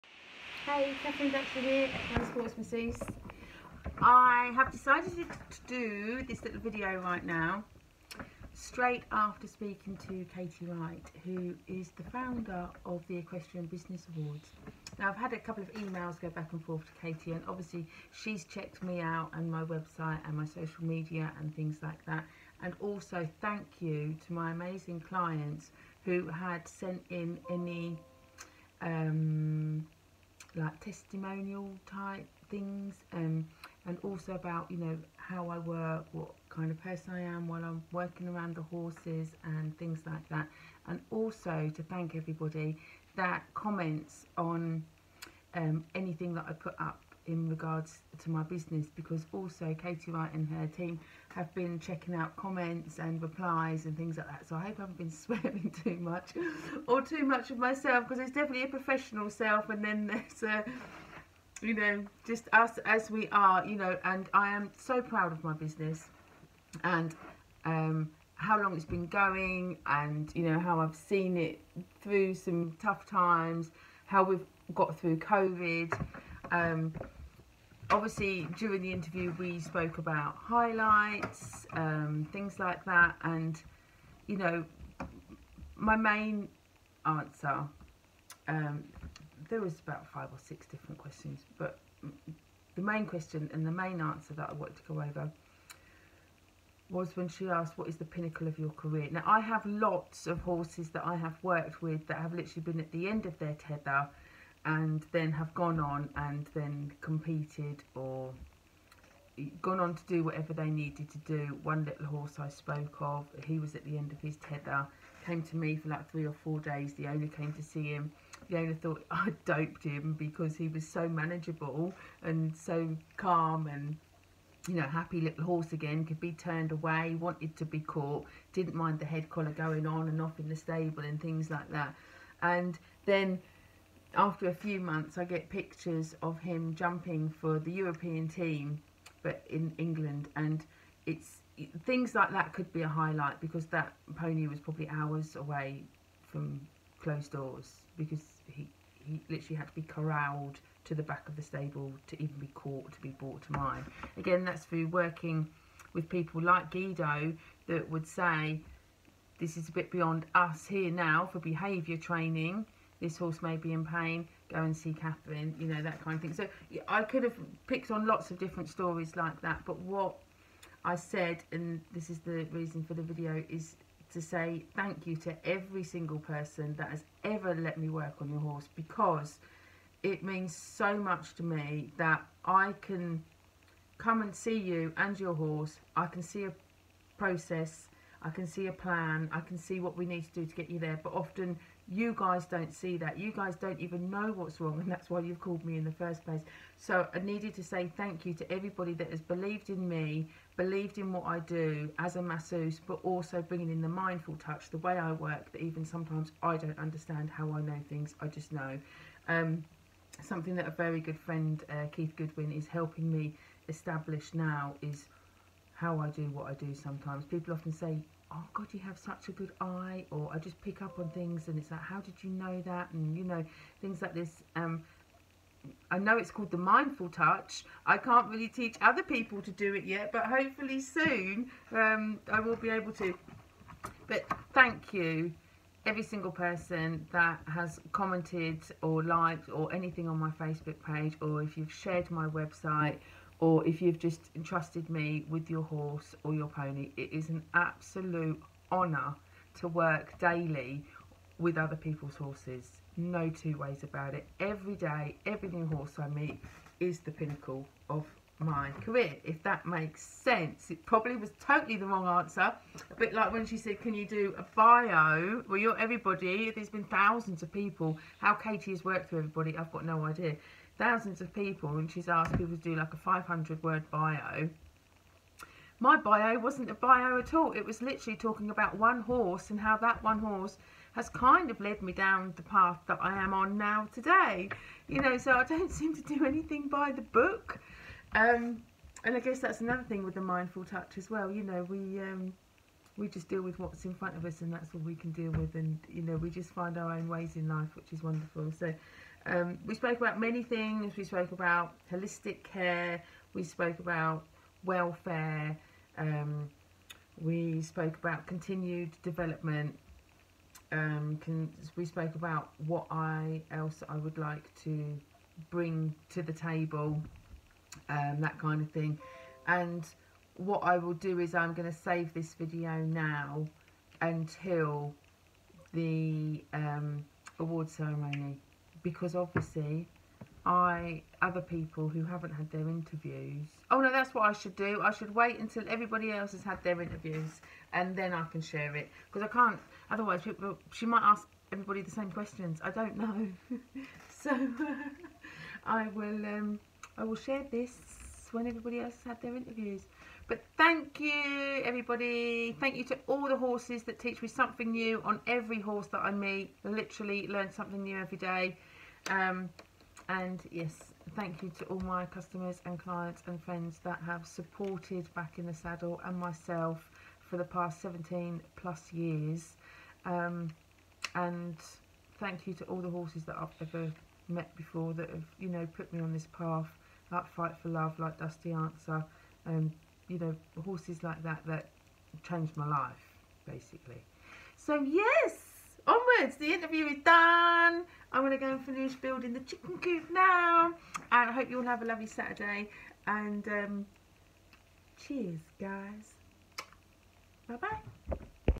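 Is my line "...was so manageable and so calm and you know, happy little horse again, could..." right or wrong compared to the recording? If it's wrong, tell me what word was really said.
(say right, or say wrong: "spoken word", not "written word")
right.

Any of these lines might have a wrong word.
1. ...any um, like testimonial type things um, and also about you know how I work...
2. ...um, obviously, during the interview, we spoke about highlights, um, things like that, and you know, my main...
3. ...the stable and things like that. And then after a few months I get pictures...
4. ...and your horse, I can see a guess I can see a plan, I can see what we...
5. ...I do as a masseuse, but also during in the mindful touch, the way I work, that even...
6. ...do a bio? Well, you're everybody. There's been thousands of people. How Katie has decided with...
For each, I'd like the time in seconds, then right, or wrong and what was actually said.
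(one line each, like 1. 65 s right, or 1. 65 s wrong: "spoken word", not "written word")
1. 27 s right
2. 76 s right
3. 130 s right
4. 184 s wrong: "process", not "guess"
5. 201 s wrong: "bringing", not "during"
6. 264 s wrong: "worked", not "decided".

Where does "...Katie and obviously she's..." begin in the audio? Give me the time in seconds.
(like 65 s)
17 s.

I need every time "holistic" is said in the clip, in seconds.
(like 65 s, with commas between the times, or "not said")
301 s.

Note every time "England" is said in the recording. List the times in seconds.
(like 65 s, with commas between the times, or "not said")
139 s.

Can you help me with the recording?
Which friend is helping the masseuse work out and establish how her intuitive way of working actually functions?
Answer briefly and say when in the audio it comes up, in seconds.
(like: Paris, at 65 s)
Keith Goodwin, at 211 s.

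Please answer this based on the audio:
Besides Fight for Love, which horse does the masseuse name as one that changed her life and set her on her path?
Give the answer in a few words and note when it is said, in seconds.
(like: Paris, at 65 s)
Dusty Answer, at 378 s.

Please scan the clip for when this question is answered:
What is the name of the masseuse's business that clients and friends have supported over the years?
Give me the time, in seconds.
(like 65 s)
365 s.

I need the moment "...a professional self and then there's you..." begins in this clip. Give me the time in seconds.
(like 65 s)
58 s.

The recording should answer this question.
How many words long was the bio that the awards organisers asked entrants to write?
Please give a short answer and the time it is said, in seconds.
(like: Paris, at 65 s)
500, at 272 s.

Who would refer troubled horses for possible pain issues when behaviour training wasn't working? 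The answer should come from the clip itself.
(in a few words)
Guido.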